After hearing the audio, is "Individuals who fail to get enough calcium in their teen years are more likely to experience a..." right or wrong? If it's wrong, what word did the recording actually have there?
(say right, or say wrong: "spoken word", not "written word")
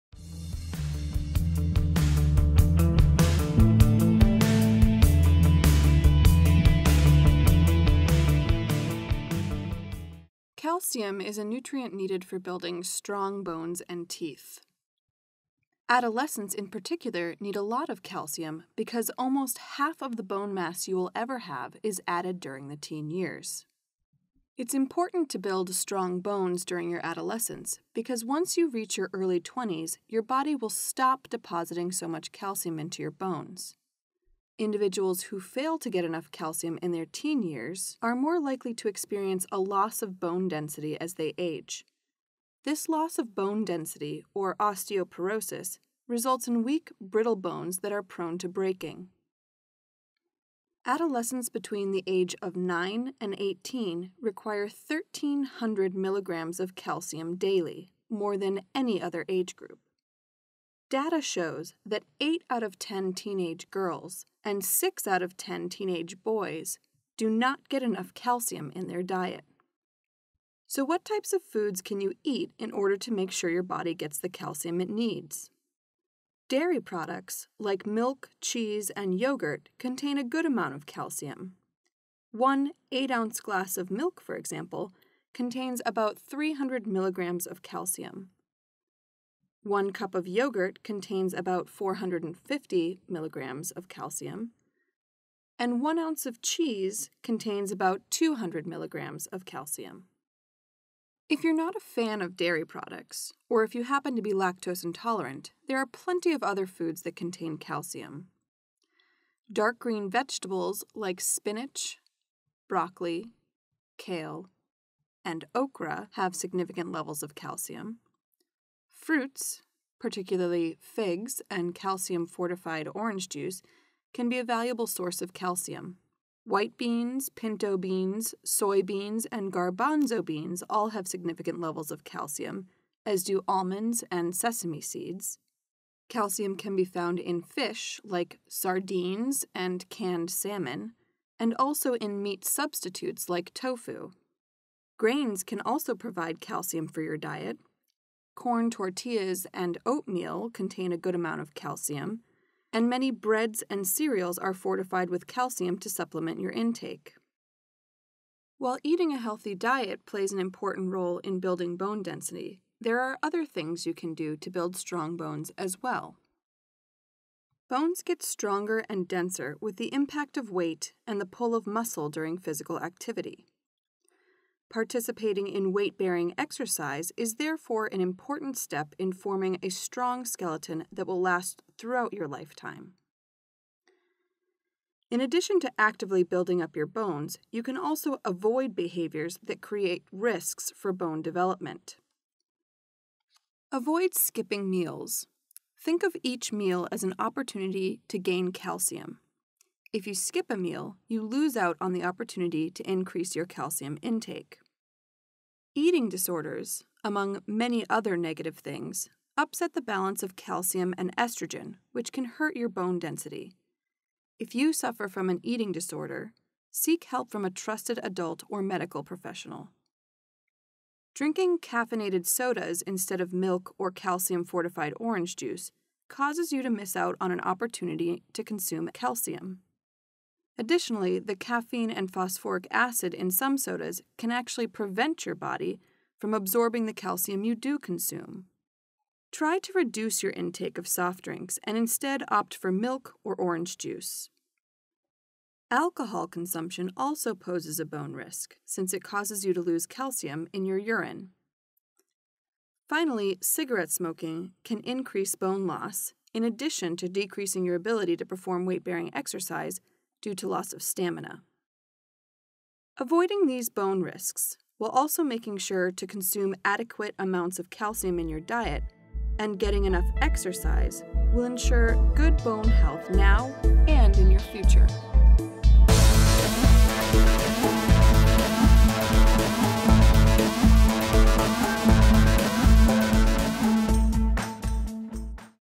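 right.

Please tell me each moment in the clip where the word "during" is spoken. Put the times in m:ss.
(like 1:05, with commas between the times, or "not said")
0:22, 0:26, 2:52.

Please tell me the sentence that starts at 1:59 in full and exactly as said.
Fruits, particularly figs and calcium fortified orange juice, can be a valuable source of calcium.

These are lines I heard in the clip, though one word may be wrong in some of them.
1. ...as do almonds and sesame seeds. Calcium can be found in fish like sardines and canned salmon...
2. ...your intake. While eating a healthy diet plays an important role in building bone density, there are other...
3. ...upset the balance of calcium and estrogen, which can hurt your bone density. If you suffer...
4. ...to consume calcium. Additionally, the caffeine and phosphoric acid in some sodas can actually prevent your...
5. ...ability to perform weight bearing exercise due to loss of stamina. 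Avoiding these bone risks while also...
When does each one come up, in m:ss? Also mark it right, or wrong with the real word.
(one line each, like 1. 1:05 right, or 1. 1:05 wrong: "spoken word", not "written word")
1. 2:13 right
2. 2:36 right
3. 3:29 right
4. 3:48 right
5. 4:17 right.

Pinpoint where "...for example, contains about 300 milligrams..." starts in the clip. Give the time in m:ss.
1:24.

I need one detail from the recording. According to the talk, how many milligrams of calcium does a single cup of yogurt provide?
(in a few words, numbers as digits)
450 milligrams.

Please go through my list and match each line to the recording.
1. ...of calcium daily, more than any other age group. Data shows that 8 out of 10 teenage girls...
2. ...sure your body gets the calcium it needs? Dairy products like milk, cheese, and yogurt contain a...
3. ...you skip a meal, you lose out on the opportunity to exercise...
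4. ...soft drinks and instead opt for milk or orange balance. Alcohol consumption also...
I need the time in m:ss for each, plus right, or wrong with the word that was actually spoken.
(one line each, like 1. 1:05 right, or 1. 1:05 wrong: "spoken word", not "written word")
1. 0:56 right
2. 1:13 right
3. 3:20 wrong: "increase", not "exercise"
4. 4:00 wrong: "juice", not "balance".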